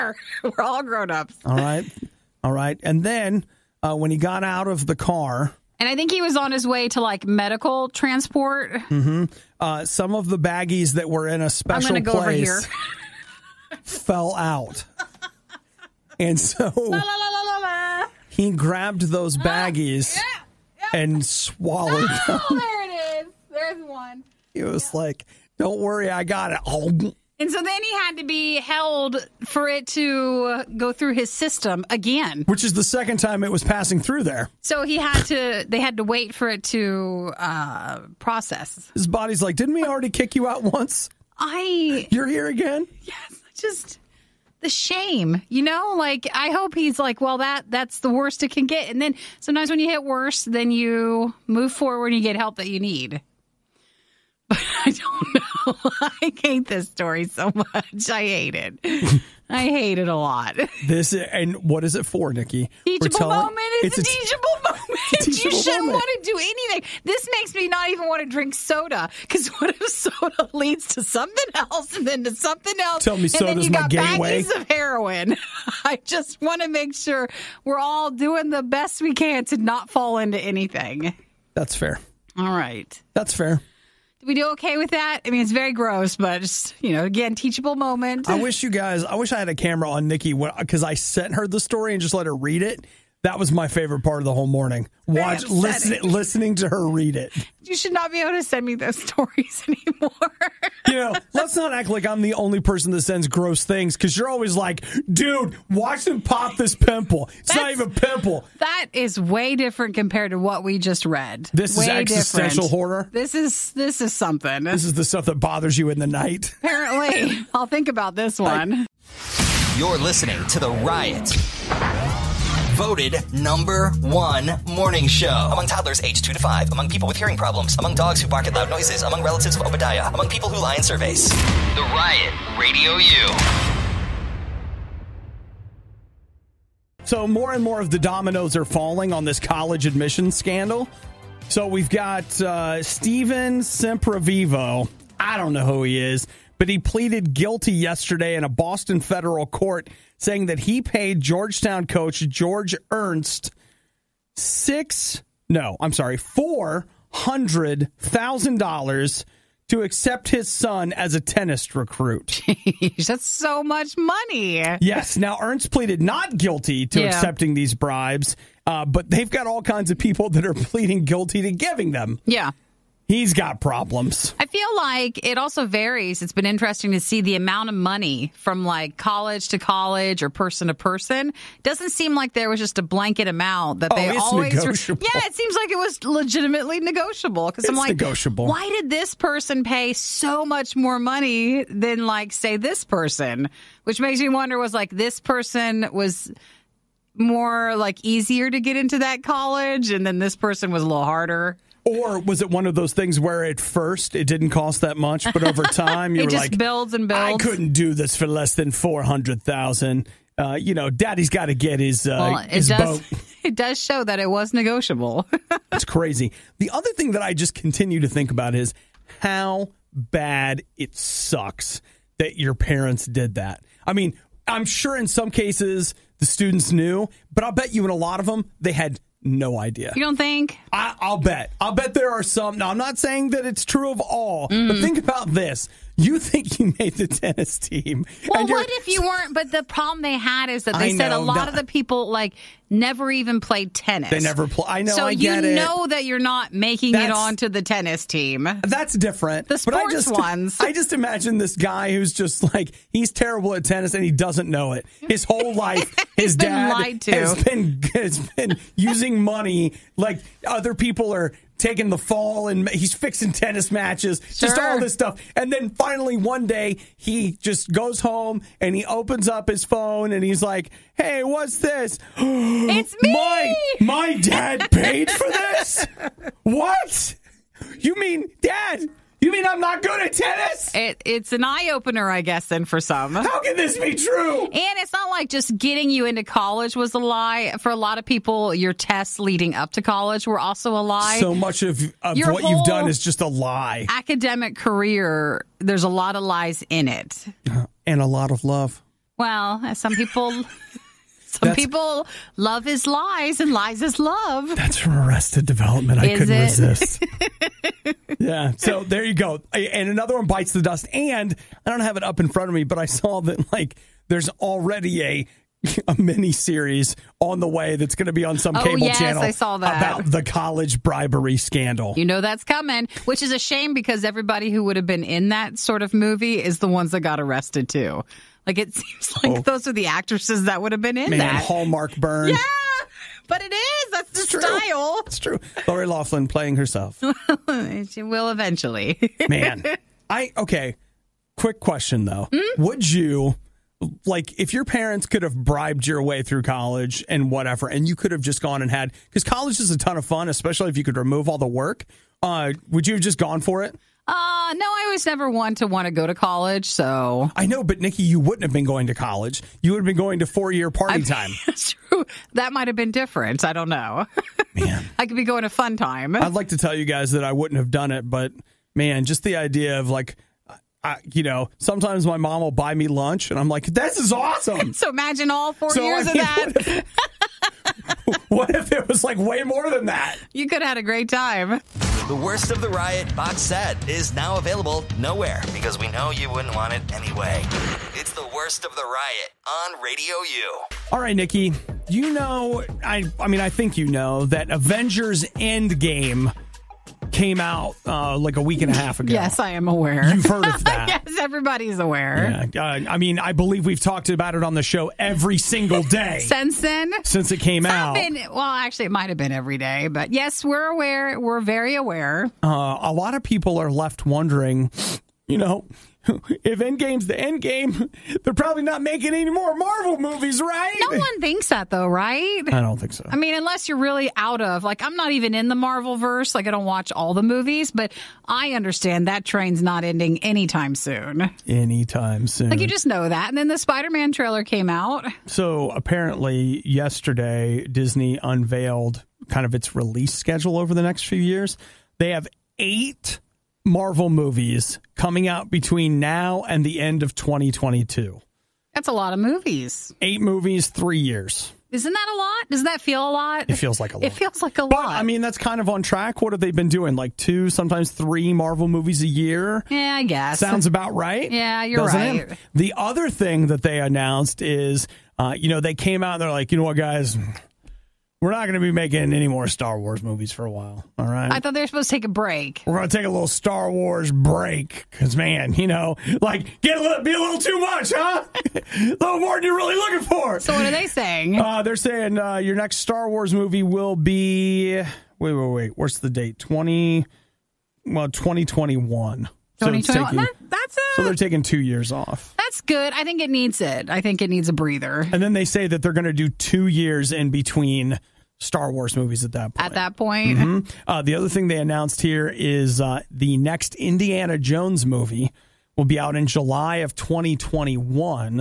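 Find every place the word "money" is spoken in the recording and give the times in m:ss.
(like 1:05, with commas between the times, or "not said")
2:43, 2:57, 3:10, 4:19.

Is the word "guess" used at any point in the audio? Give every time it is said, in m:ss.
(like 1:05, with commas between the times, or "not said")
4:42, 7:40.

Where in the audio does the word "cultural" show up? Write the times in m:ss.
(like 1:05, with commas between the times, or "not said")
not said.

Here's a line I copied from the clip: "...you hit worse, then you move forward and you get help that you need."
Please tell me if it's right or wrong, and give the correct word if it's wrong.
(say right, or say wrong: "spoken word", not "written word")
right.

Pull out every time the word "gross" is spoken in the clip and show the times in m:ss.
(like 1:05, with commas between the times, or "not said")
1:25, 1:43.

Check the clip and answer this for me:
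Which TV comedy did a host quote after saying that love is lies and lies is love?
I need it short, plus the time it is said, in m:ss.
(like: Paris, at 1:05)
Arrested Development, at 5:04.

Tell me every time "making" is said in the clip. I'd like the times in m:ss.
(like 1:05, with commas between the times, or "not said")
4:06, 6:58, 7:48.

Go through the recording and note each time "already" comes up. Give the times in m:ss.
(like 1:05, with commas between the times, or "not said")
0:39, 5:14.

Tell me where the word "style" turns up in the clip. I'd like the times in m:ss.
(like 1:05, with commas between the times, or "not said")
5:34.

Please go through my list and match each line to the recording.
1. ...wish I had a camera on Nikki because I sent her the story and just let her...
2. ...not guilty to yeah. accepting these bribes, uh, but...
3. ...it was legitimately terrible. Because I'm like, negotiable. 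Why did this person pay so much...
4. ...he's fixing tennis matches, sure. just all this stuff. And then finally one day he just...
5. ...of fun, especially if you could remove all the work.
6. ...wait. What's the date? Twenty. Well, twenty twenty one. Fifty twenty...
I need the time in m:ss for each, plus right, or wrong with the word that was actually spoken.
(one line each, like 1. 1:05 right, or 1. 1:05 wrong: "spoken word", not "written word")
1. 1:29 right
2. 2:46 right
3. 3:05 wrong: "negotiable", not "terrible"
4. 4:22 right
5. 5:49 right
6. 8:05 wrong: "Twenty", not "Fifty".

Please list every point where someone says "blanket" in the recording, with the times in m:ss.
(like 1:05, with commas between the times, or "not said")
3:02.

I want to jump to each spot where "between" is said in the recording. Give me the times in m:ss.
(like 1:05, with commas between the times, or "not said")
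7:25, 8:17.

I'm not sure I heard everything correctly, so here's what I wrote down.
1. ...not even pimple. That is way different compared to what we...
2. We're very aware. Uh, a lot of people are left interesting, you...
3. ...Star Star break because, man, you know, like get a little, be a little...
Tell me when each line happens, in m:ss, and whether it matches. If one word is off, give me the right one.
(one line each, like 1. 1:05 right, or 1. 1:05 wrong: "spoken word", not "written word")
1. 1:47 right
2. 6:51 wrong: "wondering", not "interesting"
3. 7:53 wrong: "Wars", not "Star".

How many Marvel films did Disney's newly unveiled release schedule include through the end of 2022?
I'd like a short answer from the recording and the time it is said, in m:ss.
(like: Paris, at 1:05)
8, at 7:22.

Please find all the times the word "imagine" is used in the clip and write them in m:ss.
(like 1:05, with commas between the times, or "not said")
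4:10, 6:14.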